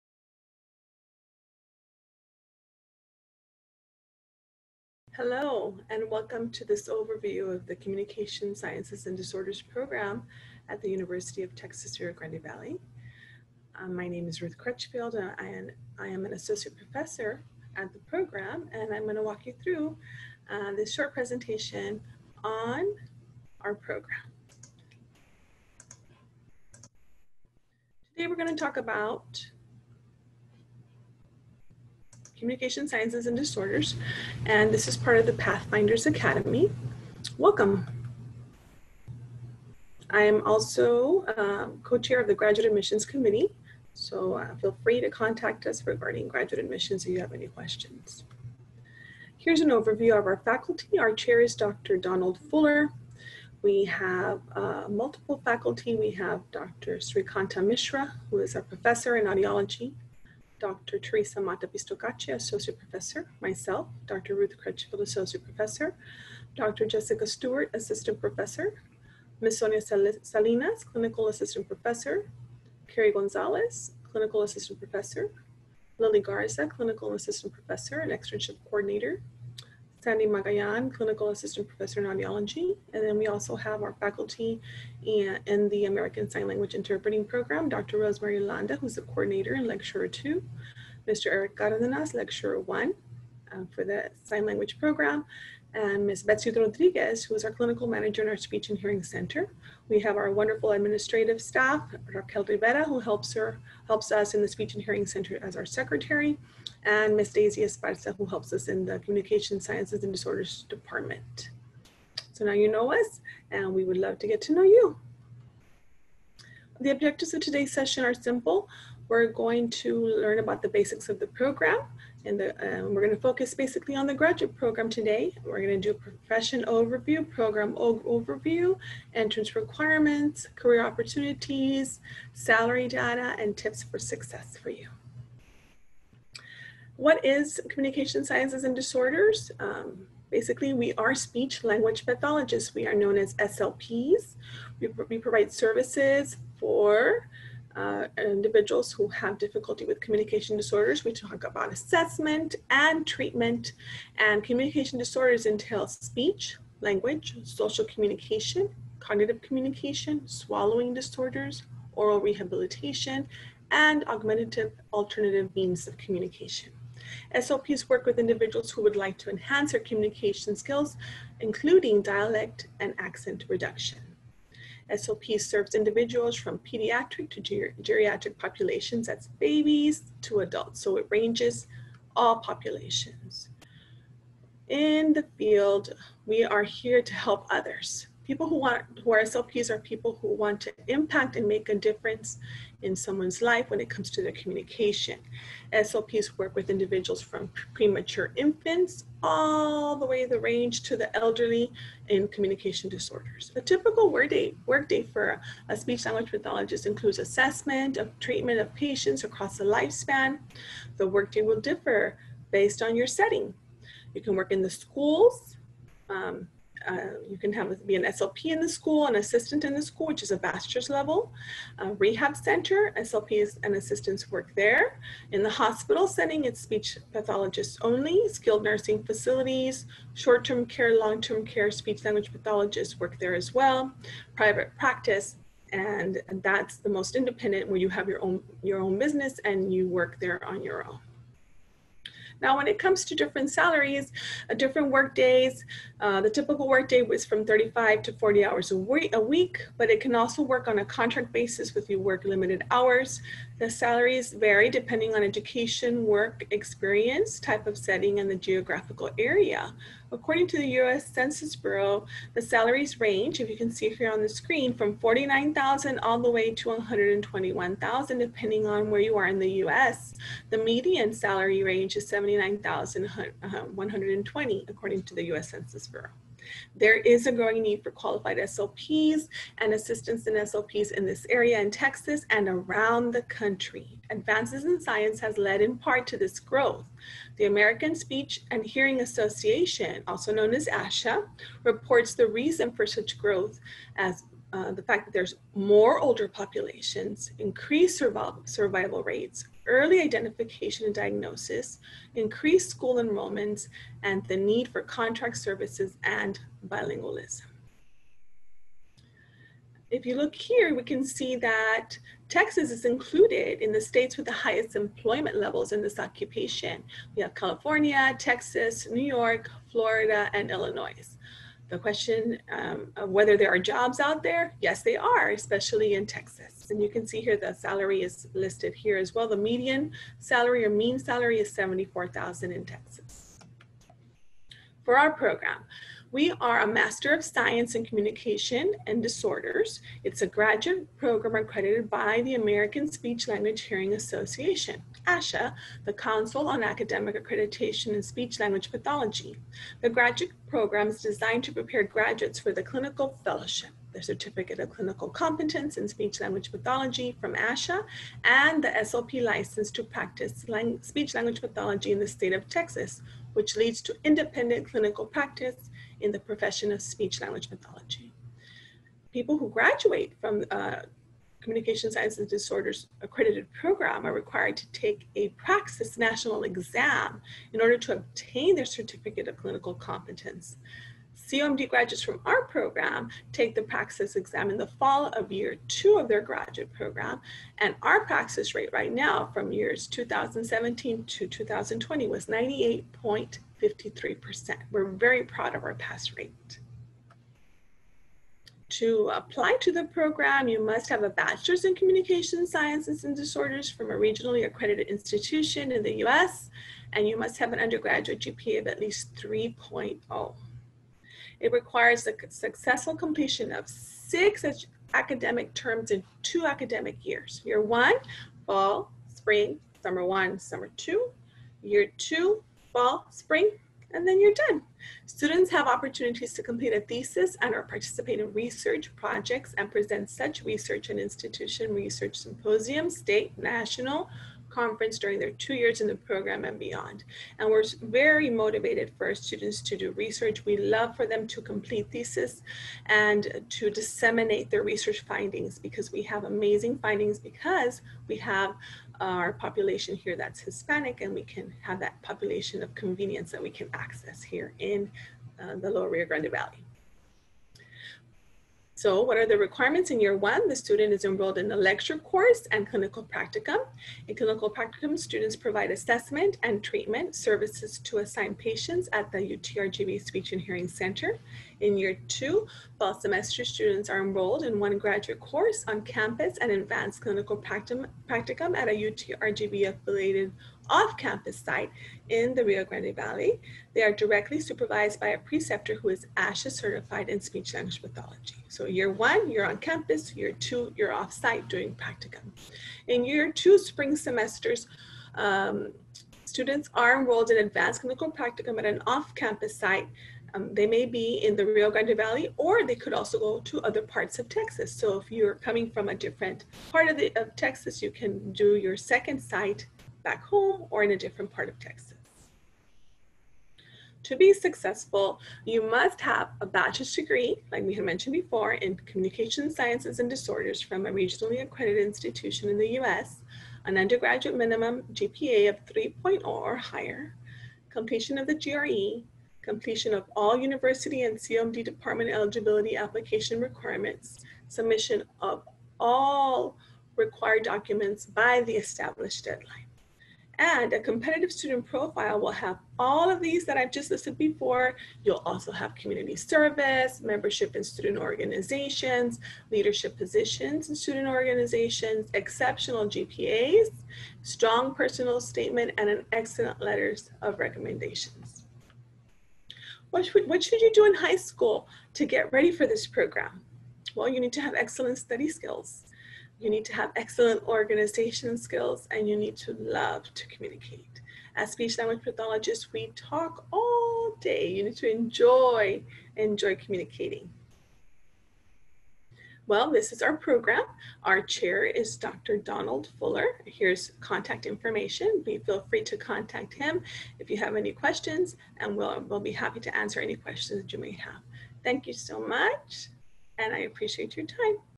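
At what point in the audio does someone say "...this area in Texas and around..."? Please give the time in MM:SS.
04:41.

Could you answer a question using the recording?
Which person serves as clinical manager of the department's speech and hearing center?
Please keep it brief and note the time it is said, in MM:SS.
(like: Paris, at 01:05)
Betsy Rodriguez, at 01:36.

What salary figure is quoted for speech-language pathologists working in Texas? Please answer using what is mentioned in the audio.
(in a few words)
74,000.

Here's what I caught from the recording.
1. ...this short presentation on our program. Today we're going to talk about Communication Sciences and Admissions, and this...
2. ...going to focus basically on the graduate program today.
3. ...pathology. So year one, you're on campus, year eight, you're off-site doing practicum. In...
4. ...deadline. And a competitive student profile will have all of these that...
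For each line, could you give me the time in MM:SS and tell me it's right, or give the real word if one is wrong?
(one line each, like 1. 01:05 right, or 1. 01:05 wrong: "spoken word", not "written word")
1. 00:20 wrong: "Disorders", not "Admissions"
2. 02:03 right
3. 08:07 wrong: "two", not "eight"
4. 08:59 right.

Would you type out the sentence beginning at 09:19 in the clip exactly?
What should, what should you do in high school to get ready for this program?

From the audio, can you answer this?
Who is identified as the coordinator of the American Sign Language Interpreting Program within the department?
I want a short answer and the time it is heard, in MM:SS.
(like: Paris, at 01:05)
Dr. Rosemary Landa, at 01:27.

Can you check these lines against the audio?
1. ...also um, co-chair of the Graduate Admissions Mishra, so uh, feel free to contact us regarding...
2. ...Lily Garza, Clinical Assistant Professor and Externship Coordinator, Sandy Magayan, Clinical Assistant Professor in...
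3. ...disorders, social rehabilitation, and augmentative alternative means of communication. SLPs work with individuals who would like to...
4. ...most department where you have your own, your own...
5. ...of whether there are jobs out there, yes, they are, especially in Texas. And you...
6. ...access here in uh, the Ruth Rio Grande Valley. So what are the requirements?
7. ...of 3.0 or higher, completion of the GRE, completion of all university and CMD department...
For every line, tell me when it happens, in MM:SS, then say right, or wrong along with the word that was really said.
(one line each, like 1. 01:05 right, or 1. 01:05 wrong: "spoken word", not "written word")
1. 00:40 wrong: "Committee", not "Mishra"
2. 01:15 right
3. 02:40 wrong: "aural", not "social"
4. 03:56 wrong: "independent", not "department"
5. 05:22 right
6. 07:33 wrong: "Lower", not "Ruth"
7. 08:45 right.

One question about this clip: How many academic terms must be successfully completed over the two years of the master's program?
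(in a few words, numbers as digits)
6.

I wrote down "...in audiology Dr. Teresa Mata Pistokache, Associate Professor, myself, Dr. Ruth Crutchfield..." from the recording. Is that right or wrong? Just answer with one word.
right.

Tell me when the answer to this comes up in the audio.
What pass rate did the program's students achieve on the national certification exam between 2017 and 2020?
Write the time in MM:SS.
06:32.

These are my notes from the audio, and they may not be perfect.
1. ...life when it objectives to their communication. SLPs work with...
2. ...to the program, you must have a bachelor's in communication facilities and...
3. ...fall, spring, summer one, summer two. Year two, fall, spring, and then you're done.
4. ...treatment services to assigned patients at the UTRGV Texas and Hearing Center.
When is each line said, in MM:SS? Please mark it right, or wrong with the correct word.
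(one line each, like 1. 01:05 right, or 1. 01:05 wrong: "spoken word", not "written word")
1. 03:13 wrong: "comes", not "objectives"
2. 06:39 wrong: "sciences", not "facilities"
3. 06:58 right
4. 07:46 wrong: "Speech", not "Texas".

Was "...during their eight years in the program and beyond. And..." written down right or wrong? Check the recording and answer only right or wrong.
wrong.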